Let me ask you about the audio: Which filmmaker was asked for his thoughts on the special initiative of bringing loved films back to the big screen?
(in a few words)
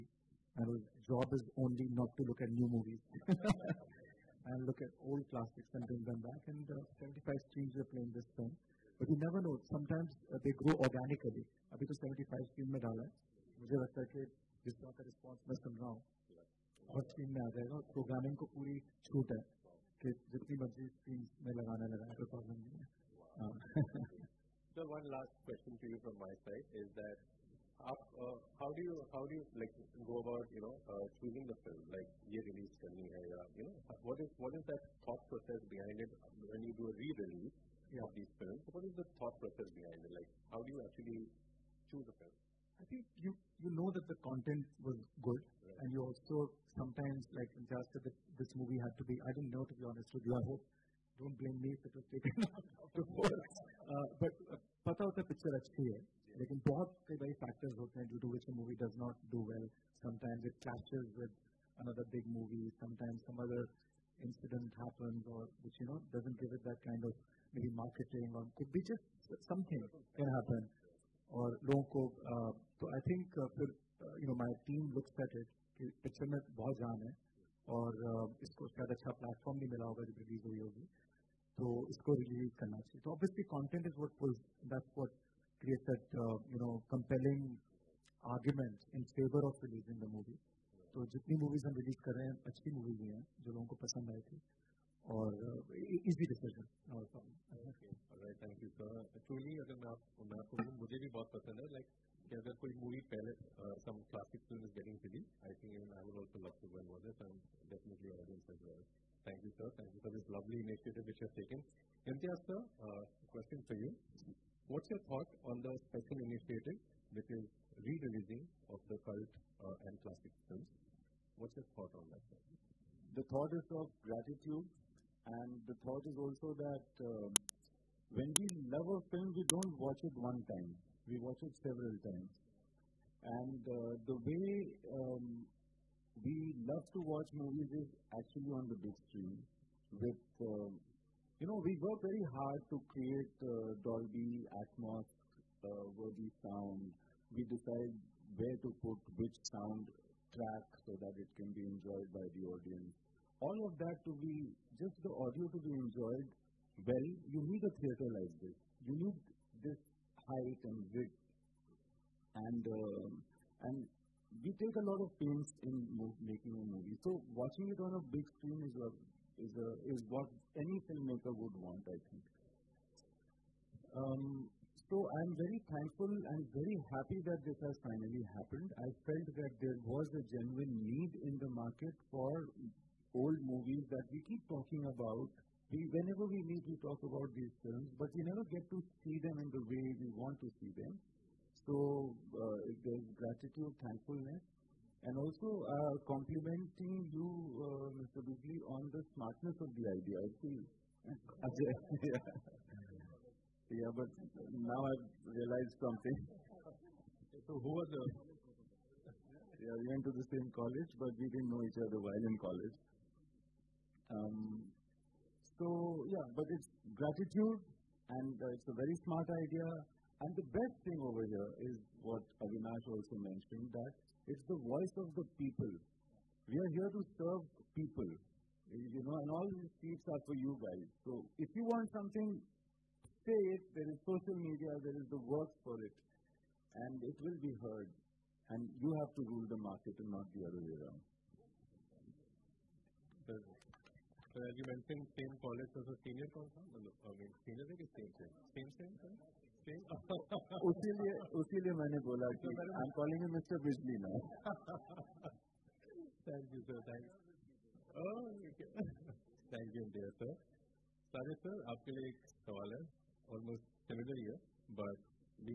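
Imtiaz.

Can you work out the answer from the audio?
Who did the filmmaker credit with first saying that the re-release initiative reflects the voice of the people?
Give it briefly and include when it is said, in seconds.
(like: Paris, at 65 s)
Avinash, at 222 s.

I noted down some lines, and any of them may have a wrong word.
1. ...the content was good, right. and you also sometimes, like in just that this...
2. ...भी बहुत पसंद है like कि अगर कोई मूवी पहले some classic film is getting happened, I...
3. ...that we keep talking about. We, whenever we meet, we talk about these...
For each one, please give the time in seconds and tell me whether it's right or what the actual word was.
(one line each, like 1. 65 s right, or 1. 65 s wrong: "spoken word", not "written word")
1. 44 s right
2. 101 s wrong: "released", not "happened"
3. 183 s right.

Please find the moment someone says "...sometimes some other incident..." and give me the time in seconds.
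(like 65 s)
62 s.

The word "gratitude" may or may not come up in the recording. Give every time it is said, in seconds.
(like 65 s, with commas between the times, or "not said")
193 s, 216 s.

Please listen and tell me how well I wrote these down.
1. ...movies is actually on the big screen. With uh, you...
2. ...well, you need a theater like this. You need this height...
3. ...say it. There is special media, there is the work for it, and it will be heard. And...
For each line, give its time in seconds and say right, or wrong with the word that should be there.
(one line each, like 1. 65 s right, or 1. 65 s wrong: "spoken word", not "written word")
1. 137 s right
2. 156 s right
3. 233 s wrong: "social", not "special".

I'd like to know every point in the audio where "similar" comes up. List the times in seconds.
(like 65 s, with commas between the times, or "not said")
263 s.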